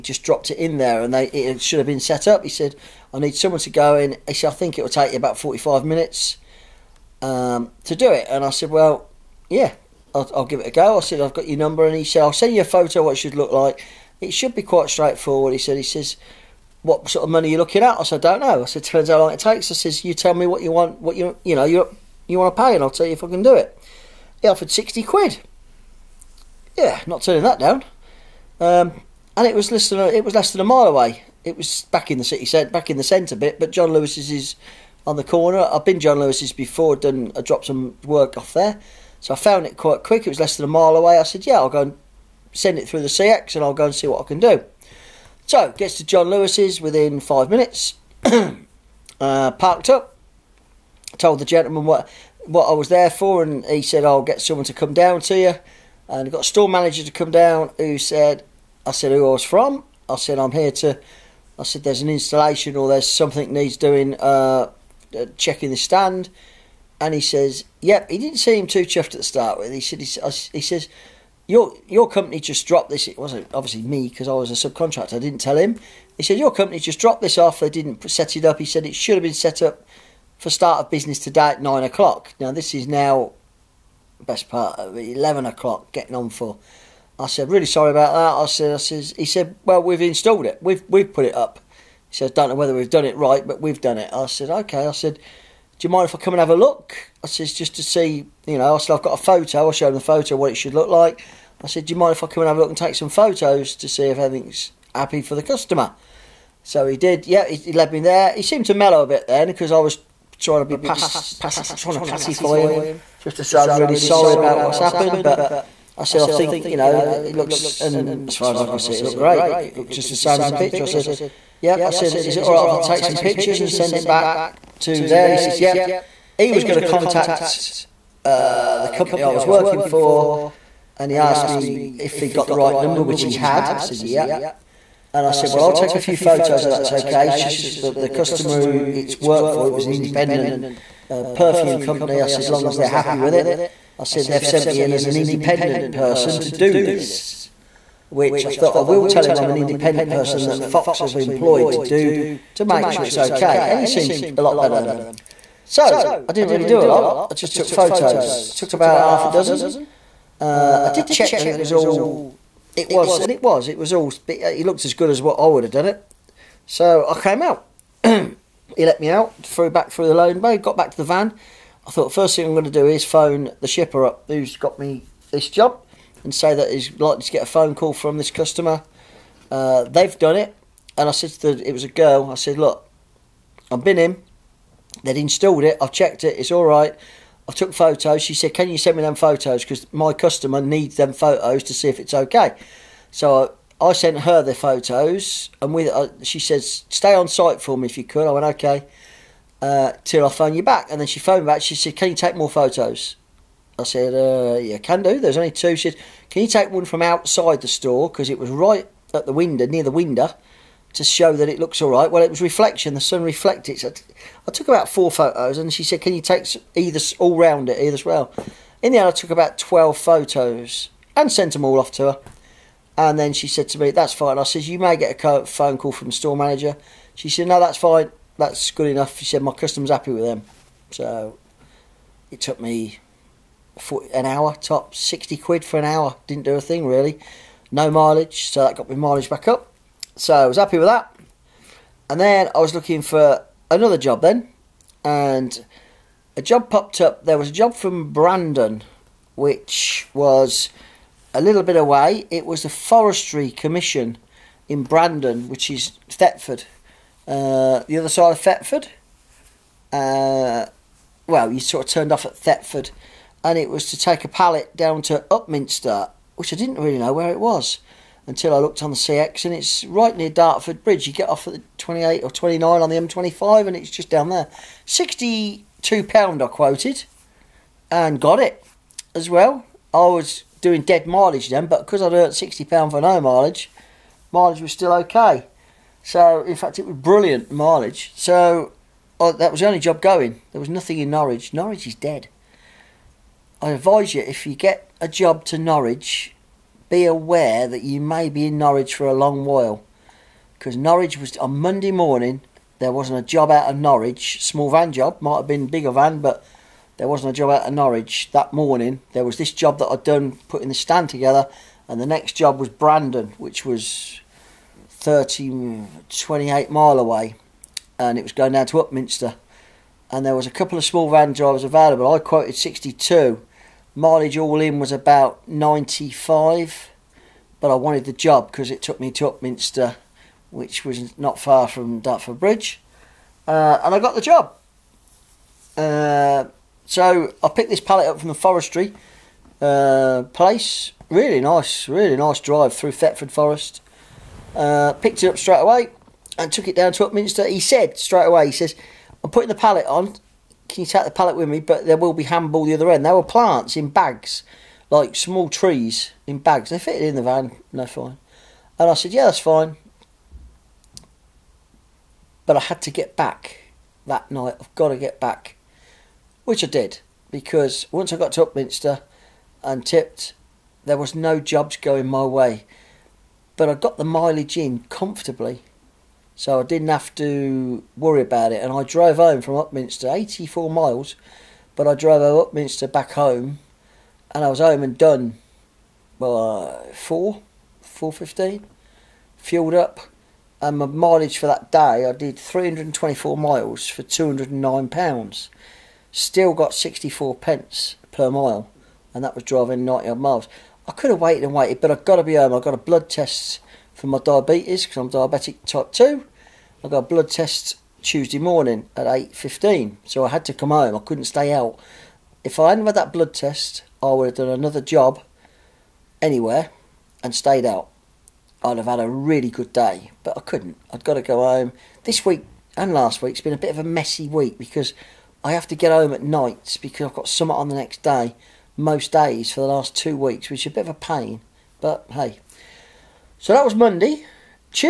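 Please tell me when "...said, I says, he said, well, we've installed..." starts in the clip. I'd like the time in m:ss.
1:28.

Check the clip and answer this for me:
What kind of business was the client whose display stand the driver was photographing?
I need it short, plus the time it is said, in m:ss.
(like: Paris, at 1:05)
perfume company, at 2:21.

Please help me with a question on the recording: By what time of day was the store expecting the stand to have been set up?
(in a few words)
9 o'clock.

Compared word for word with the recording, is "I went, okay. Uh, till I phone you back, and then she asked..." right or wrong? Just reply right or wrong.
wrong.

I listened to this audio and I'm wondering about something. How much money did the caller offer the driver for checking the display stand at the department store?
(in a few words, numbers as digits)
60 quid.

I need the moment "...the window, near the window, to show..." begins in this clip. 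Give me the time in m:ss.
3:29.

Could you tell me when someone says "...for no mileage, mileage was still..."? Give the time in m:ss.
4:42.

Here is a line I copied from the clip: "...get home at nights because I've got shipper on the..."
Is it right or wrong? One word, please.
wrong.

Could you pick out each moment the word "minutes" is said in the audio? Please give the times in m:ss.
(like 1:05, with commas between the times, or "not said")
0:05, 0:47.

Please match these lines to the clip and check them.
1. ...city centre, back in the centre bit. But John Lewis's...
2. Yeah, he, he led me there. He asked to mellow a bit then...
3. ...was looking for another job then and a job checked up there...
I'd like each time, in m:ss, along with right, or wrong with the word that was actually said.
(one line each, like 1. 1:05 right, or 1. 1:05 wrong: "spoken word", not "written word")
1. 0:32 right
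2. 1:47 wrong: "seemed", not "asked"
3. 4:02 wrong: "popped", not "checked".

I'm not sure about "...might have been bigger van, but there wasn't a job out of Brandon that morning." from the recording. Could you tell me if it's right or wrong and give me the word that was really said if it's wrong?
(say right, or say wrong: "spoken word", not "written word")
wrong: "Norwich", not "Brandon".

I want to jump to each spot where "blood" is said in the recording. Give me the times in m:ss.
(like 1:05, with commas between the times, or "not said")
6:42, 6:47, 6:53.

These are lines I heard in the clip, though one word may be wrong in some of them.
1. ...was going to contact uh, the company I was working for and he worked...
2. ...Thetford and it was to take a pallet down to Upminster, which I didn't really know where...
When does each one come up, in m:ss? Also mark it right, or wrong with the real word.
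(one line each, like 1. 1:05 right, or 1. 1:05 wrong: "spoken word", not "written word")
1. 2:06 wrong: "asked", not "worked"
2. 4:22 right.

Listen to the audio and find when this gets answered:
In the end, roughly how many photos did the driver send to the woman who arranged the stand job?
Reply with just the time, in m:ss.
3:39.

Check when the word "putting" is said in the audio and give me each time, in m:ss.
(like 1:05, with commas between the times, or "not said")
5:10, 5:49.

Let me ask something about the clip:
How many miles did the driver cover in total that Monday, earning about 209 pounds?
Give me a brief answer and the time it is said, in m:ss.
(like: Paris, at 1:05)
324 miles, at 6:32.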